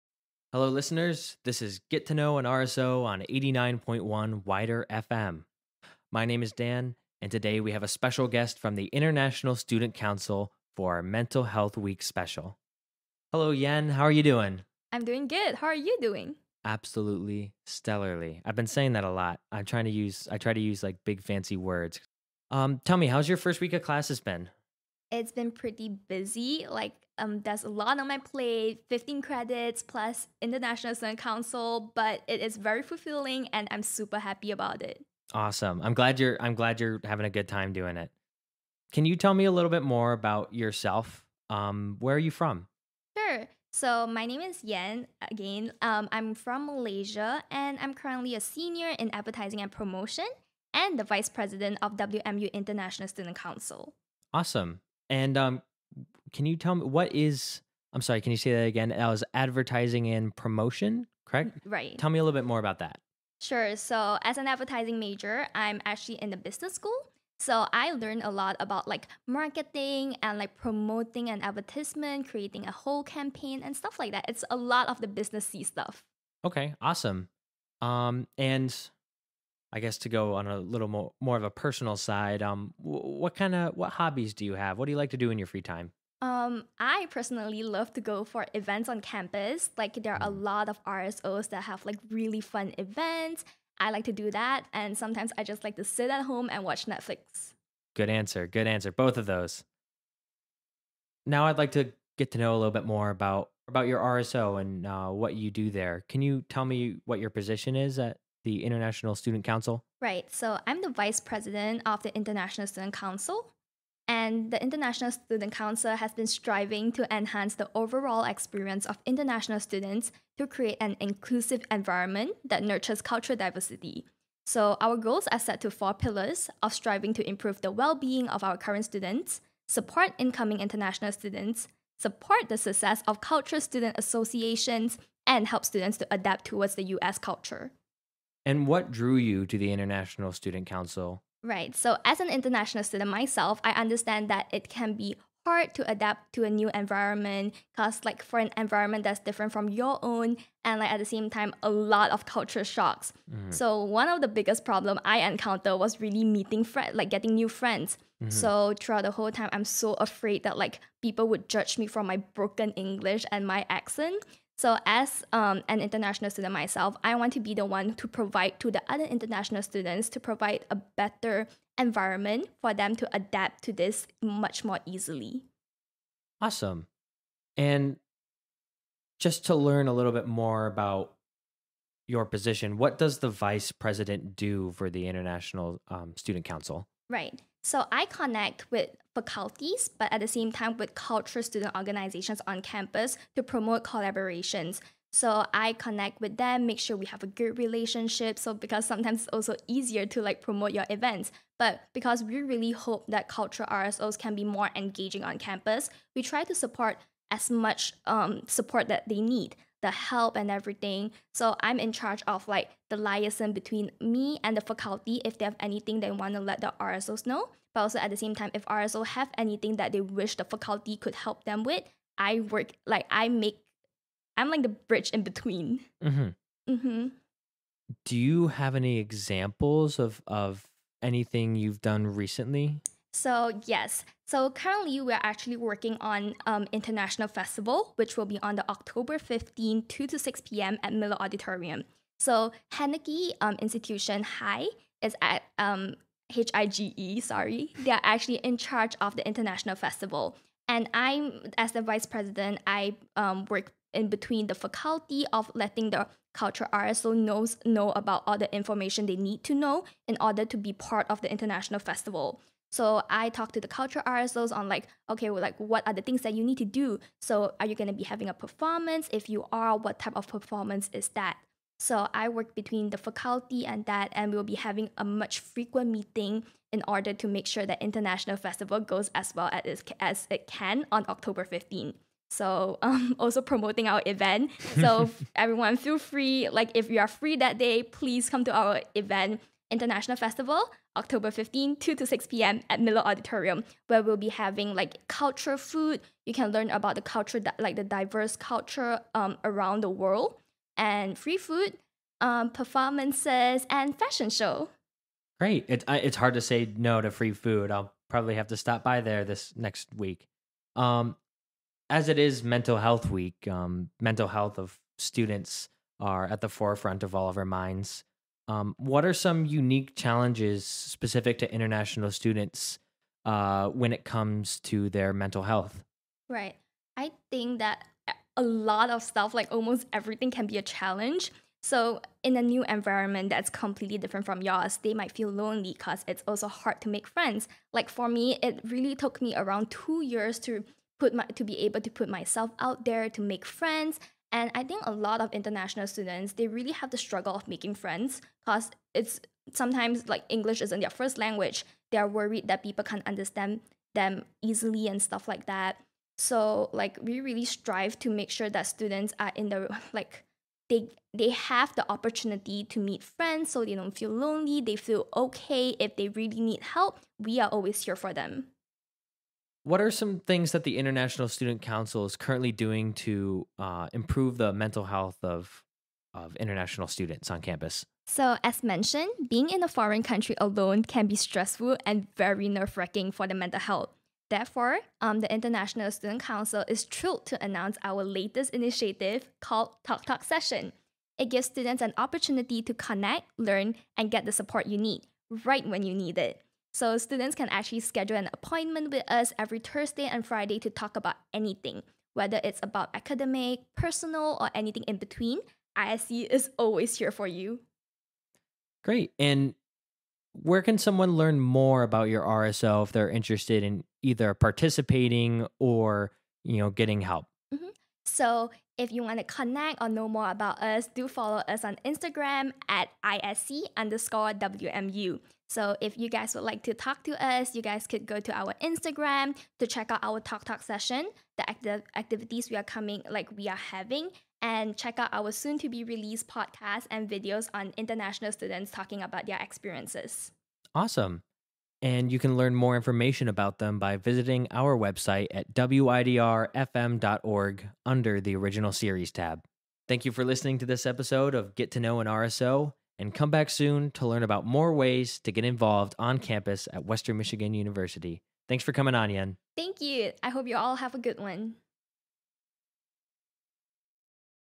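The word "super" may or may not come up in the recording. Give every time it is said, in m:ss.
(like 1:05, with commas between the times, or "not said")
0:33.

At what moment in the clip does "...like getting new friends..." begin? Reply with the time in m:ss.
2:36.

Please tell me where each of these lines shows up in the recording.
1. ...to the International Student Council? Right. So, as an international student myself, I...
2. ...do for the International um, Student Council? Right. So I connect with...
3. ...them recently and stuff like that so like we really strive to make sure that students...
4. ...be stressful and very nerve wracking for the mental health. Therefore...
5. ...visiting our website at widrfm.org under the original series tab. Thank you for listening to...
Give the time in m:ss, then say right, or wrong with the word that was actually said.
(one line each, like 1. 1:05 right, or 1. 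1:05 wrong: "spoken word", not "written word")
1. 2:19 right
2. 3:04 right
3. 5:53 wrong: "easily", not "recently"
4. 6:21 right
5. 7:23 right.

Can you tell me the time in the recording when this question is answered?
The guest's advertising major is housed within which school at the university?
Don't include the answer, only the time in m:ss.
1:06.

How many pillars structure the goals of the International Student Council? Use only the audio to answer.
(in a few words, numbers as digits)
4.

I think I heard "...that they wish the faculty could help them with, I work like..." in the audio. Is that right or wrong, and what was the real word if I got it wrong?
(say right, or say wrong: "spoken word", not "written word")
right.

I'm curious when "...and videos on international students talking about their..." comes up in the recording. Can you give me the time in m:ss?
7:16.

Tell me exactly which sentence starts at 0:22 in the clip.
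Um, tell me, how's your first week of classes been?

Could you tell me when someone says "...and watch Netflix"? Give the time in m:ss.
1:36.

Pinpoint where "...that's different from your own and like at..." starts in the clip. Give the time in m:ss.
2:29.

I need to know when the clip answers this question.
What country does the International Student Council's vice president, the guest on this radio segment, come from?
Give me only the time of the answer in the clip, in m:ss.
0:46.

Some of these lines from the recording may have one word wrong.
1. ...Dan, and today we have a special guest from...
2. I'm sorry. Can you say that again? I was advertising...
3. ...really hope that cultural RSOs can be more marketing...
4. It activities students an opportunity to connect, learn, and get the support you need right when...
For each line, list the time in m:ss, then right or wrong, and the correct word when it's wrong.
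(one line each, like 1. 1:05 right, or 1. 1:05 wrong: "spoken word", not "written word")
1. 0:06 right
2. 0:57 right
3. 3:22 wrong: "engaging", not "marketing"
4. 6:31 wrong: "gives", not "activities".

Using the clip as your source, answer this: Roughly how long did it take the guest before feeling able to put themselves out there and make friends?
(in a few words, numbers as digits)
2 years.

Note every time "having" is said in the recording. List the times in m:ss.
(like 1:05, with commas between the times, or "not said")
0:37, 4:28, 4:34, 4:54, 7:13.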